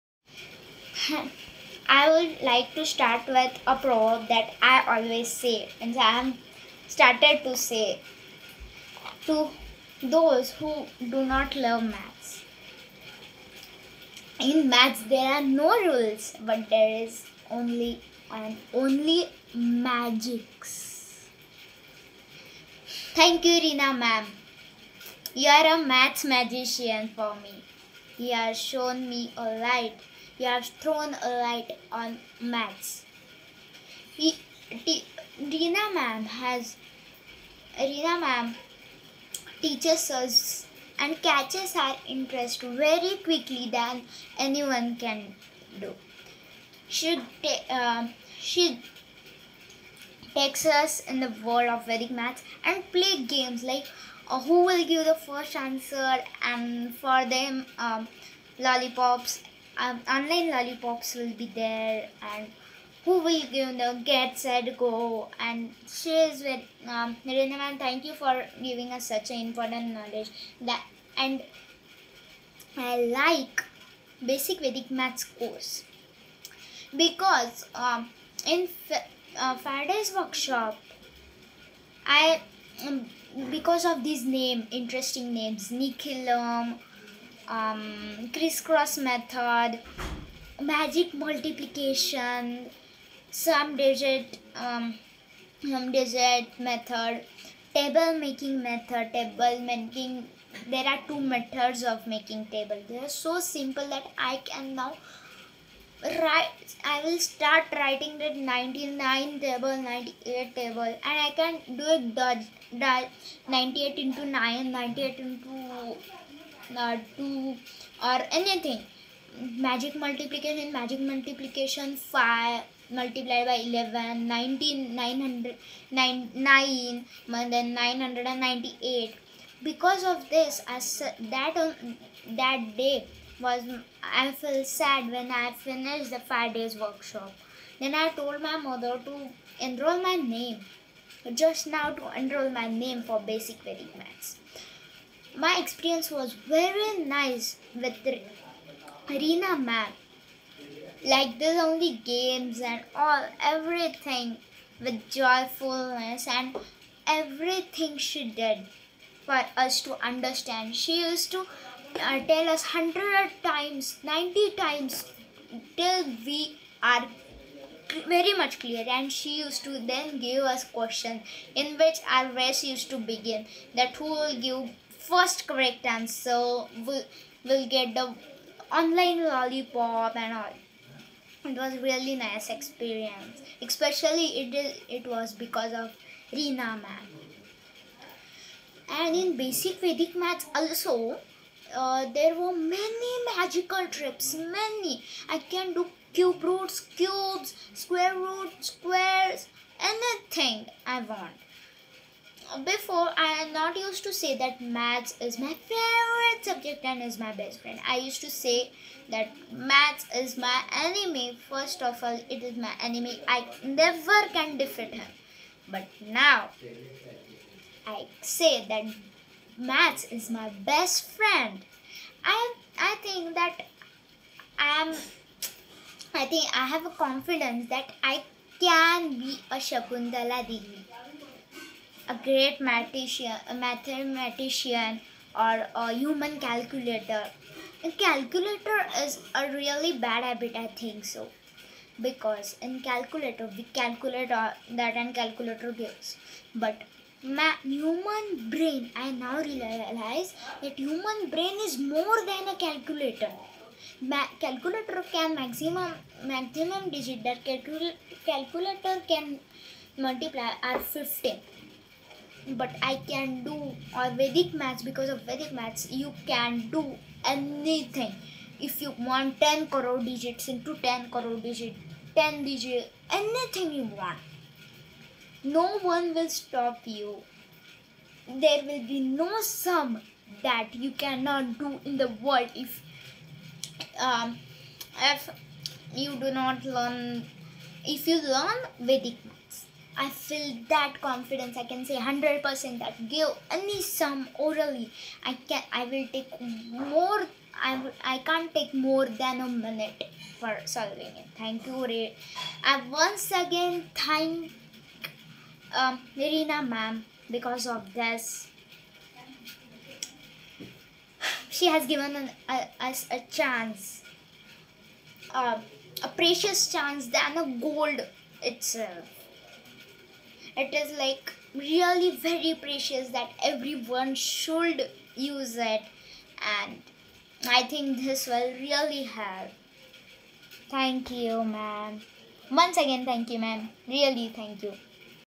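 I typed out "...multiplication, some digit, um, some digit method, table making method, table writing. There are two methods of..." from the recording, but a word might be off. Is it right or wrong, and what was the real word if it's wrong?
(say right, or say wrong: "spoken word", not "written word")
wrong: "making", not "writing".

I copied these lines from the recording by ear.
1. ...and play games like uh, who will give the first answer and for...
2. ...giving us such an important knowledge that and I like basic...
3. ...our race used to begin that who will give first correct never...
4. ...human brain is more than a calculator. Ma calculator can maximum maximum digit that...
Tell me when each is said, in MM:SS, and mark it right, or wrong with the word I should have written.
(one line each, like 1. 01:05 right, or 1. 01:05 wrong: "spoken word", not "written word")
1. 00:52 right
2. 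01:08 right
3. 02:52 wrong: "answer", not "never"
4. 04:10 right.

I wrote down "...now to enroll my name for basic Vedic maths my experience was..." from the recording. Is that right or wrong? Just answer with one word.
right.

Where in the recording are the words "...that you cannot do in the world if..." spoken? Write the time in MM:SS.
04:40.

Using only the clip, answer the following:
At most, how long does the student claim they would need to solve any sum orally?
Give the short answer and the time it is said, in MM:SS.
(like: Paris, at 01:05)
A minute, at 04:59.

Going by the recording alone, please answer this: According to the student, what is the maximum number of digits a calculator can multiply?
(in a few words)
15.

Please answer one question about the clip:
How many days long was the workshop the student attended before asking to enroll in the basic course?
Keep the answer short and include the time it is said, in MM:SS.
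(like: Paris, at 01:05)
5, at 02:16.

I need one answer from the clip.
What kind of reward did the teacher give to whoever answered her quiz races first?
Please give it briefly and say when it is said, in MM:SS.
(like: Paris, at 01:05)
Online lollipops, at 01:00.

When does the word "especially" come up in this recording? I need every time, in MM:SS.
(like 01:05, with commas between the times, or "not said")
03:03.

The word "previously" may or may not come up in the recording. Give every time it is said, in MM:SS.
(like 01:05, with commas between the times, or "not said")
not said.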